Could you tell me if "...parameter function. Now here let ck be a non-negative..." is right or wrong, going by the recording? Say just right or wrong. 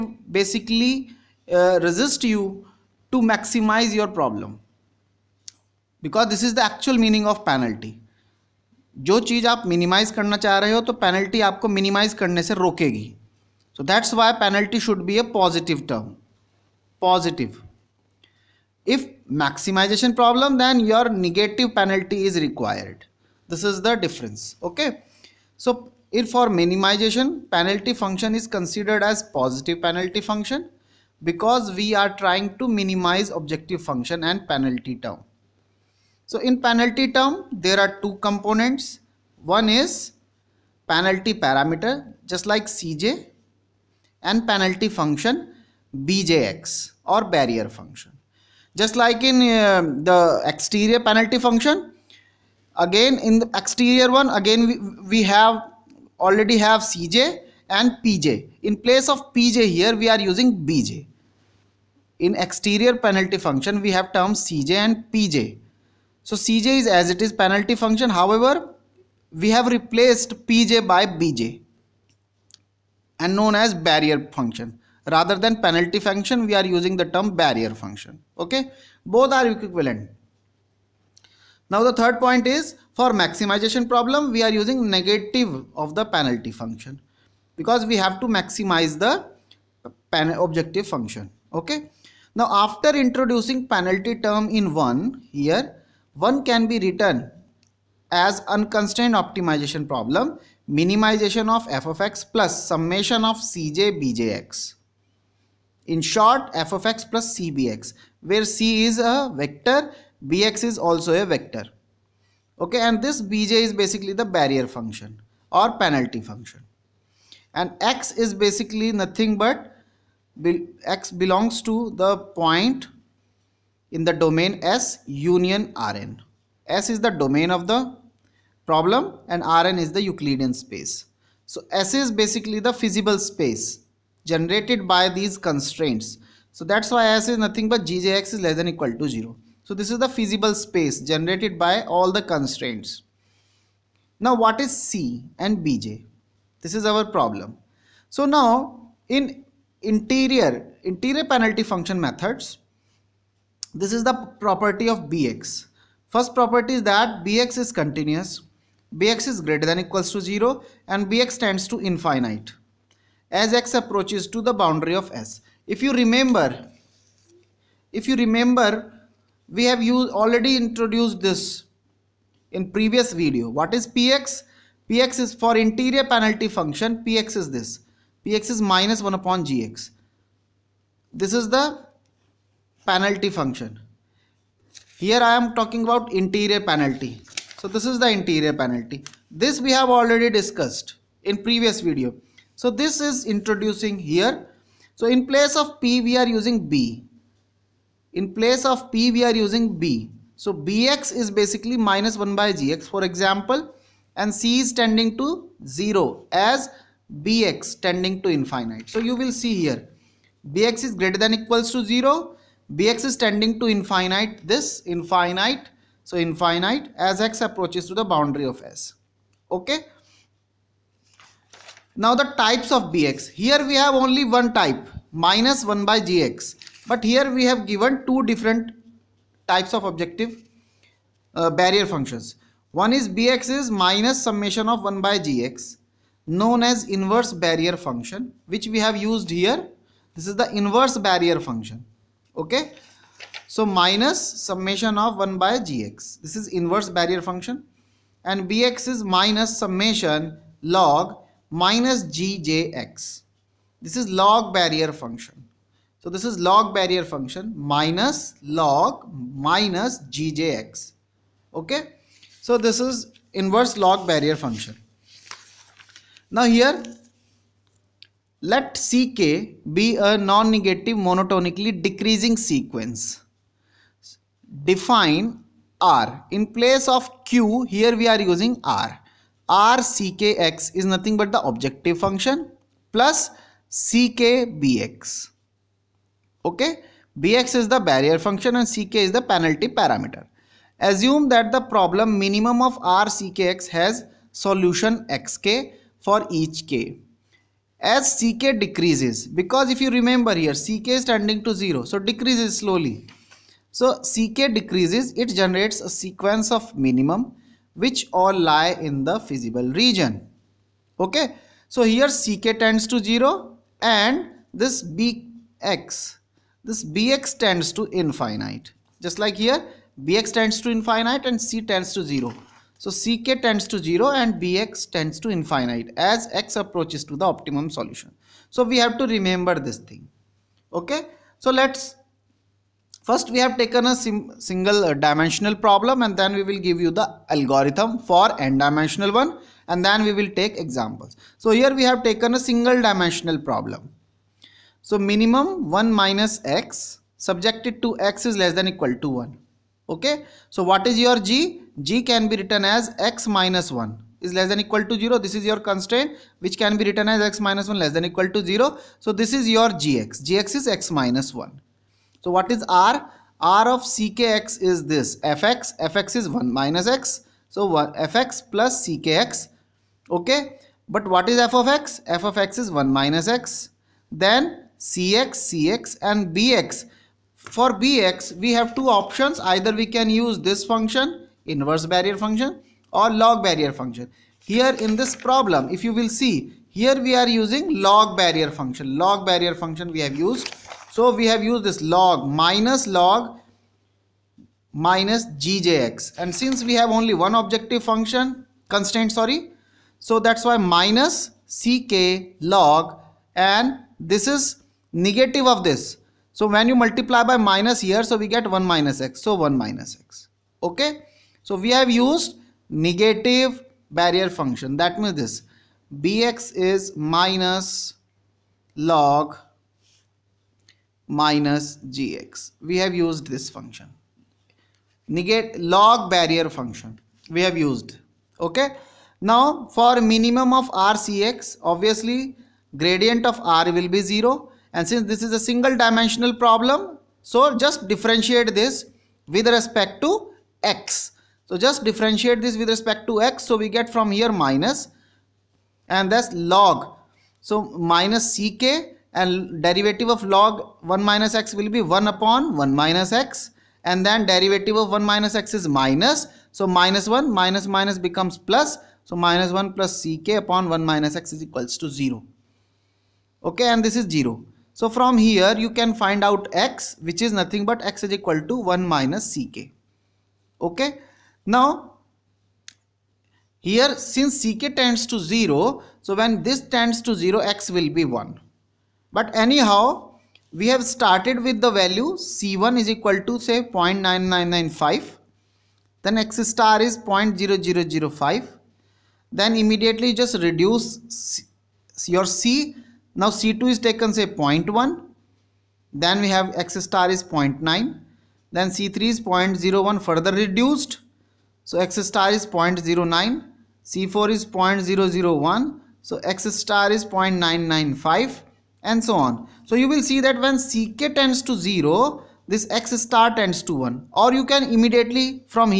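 wrong.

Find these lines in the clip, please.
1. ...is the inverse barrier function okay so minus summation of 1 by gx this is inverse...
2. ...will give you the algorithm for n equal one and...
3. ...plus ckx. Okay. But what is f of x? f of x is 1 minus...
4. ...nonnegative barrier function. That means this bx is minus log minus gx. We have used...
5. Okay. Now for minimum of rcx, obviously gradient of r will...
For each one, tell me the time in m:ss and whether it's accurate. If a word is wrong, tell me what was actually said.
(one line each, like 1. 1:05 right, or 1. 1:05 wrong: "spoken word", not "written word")
1. 4:00 right
2. 5:36 wrong: "dimensional", not "equal"
3. 6:08 right
4. 6:52 wrong: "negative", not "nonnegative"
5. 7:08 right.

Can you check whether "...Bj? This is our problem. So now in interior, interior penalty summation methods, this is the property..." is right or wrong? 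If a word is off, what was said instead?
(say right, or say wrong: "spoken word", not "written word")
wrong: "function", not "summation".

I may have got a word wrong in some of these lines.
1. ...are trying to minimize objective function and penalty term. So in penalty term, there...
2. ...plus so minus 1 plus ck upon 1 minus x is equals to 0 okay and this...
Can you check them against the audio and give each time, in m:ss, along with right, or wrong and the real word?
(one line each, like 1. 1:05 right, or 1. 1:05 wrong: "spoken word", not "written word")
1. 0:31 right
2. 7:38 right.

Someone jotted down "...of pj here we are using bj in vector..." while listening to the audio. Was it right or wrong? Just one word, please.
wrong.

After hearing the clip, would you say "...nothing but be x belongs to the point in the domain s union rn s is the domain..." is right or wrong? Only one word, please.
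right.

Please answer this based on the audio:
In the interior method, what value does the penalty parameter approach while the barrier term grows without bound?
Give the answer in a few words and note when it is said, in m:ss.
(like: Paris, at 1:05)
0, at 3:24.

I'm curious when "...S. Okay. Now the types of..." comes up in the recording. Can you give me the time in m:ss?
3:38.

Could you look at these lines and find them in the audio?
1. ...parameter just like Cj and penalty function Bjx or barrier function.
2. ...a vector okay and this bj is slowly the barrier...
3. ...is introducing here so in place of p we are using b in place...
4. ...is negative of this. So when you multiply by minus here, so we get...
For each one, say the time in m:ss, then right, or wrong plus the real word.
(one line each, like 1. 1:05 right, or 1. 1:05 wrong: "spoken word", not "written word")
1. 0:41 right
2. 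1:51 wrong: "basically", not "slowly"
3. 3:13 right
4. 6:44 right.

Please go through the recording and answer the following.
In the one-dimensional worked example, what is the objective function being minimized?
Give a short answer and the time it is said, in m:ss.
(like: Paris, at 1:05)
1 minus x, at 5:44.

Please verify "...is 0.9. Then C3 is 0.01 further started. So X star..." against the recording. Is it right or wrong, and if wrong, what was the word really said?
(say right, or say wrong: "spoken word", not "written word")
wrong: "reduced", not "started".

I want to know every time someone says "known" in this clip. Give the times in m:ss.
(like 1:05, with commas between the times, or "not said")
1:13, 3:56.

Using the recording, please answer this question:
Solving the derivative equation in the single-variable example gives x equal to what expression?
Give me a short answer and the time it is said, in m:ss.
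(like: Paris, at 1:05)
1 minus ck, at 7:47.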